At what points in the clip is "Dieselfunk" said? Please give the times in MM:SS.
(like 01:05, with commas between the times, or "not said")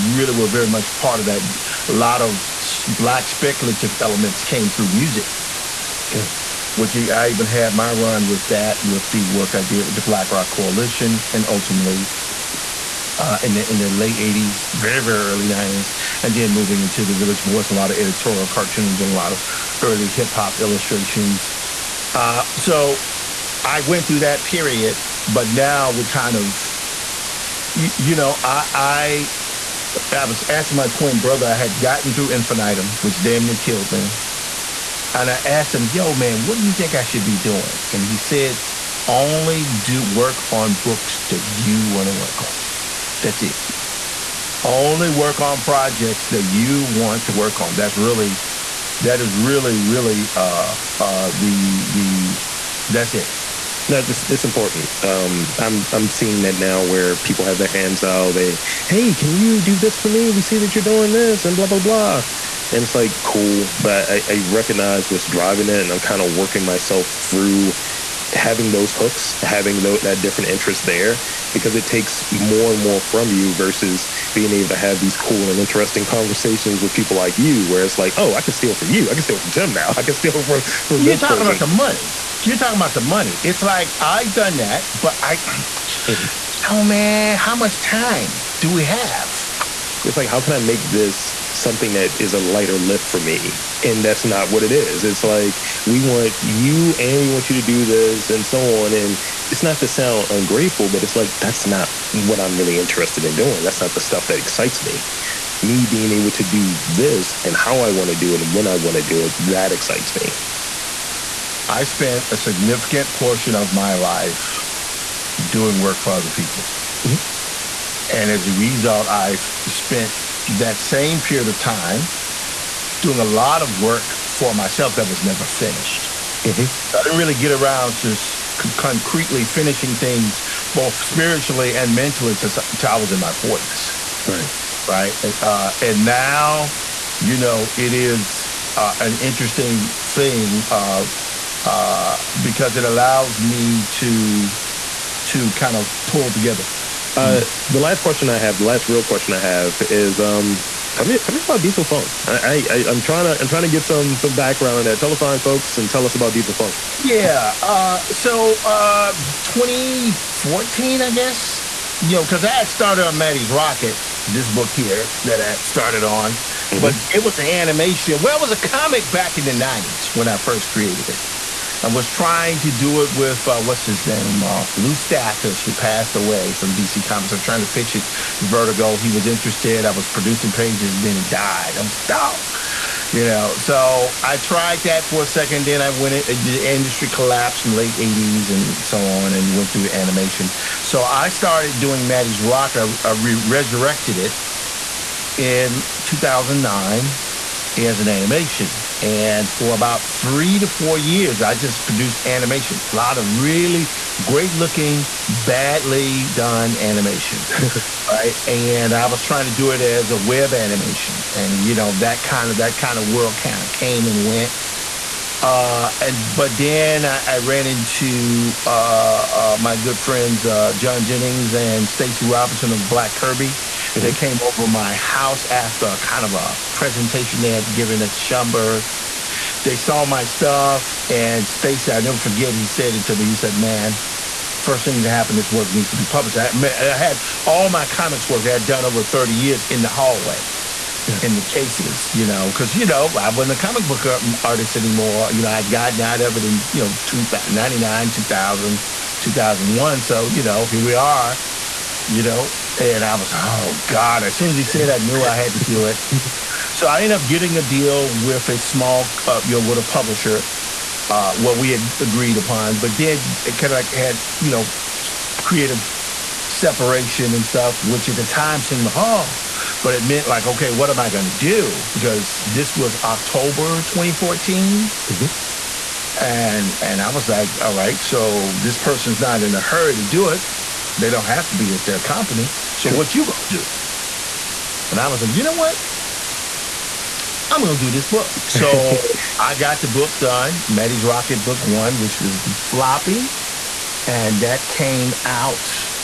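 02:31, 02:36.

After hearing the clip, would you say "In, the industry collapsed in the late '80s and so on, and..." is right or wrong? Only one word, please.
right.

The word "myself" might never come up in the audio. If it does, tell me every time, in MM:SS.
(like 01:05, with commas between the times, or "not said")
01:06, 02:04.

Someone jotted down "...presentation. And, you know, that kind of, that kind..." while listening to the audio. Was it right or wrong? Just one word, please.
wrong.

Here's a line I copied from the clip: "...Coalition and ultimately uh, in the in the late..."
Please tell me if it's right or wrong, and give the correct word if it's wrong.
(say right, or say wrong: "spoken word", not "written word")
right.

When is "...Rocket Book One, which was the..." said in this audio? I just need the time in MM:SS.
04:51.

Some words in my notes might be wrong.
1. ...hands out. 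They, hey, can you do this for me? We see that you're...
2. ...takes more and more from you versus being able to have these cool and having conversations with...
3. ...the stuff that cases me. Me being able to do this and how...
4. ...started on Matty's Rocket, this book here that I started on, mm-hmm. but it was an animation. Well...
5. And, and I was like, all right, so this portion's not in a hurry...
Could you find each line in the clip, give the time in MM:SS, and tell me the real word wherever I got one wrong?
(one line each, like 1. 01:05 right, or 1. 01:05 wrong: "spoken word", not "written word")
1. 00:57 right
2. 01:11 wrong: "interesting", not "having"
3. 01:43 wrong: "excites", not "cases"
4. 02:42 right
5. 04:36 wrong: "person", not "portion".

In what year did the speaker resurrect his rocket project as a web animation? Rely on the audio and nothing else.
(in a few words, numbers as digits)
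2009.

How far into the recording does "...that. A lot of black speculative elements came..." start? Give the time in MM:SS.
00:01.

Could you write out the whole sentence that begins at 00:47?
That's really, that is really, really, uh, uh, the, the, that's it.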